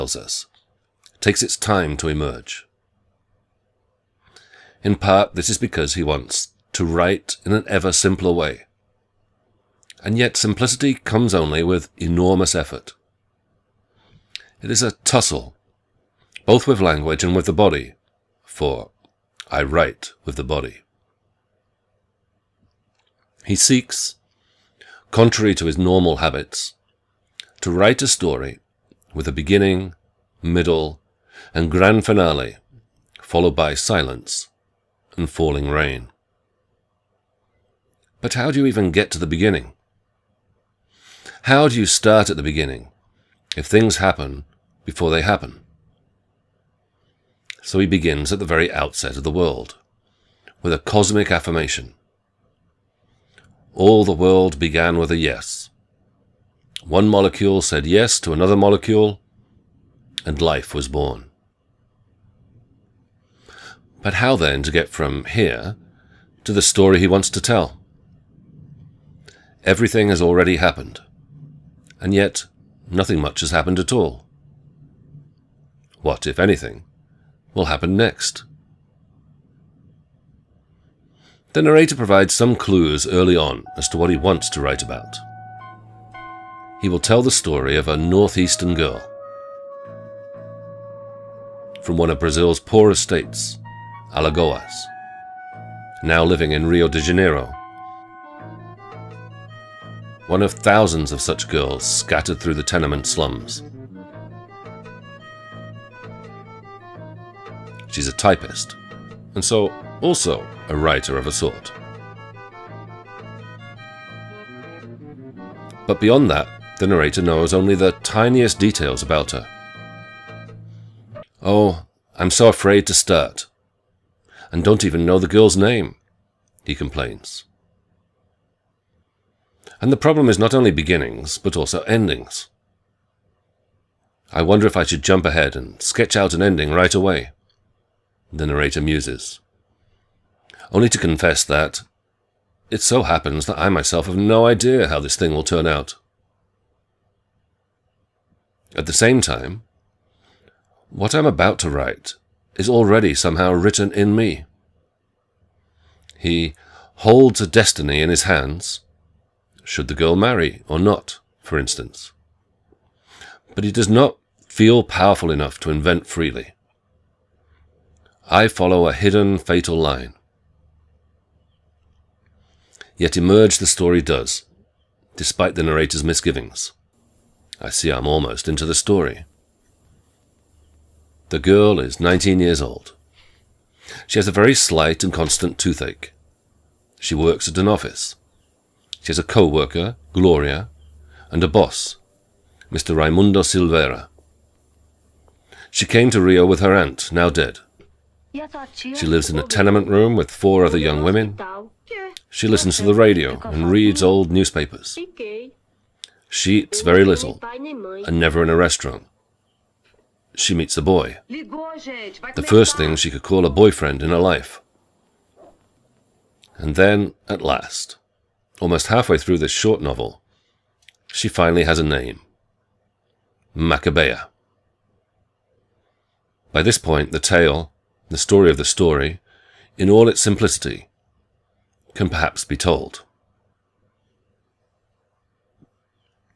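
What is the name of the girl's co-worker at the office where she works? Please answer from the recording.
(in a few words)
Gloria.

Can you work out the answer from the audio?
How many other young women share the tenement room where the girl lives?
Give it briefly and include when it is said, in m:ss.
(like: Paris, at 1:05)
4, at 3:20.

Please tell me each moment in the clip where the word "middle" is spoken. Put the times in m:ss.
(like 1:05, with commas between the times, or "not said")
0:30.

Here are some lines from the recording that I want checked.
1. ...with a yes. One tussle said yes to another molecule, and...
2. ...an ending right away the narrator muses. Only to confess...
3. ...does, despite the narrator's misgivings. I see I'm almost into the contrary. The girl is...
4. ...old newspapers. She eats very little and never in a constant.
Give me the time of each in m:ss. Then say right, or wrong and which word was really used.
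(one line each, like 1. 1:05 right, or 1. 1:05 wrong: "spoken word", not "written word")
1. 0:54 wrong: "molecule", not "tussle"
2. 2:16 right
3. 2:53 wrong: "story", not "contrary"
4. 3:24 wrong: "restaurant", not "constant".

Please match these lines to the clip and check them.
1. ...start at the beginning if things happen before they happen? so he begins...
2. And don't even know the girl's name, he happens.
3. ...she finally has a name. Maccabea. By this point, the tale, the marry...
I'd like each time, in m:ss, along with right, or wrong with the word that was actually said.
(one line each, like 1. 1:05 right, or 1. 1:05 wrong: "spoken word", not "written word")
1. 0:41 right
2. 2:04 wrong: "complains", not "happens"
3. 3:41 wrong: "story", not "marry".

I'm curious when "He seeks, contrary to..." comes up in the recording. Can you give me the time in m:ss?
0:23.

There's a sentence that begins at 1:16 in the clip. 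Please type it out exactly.
What, if anything, will happen next.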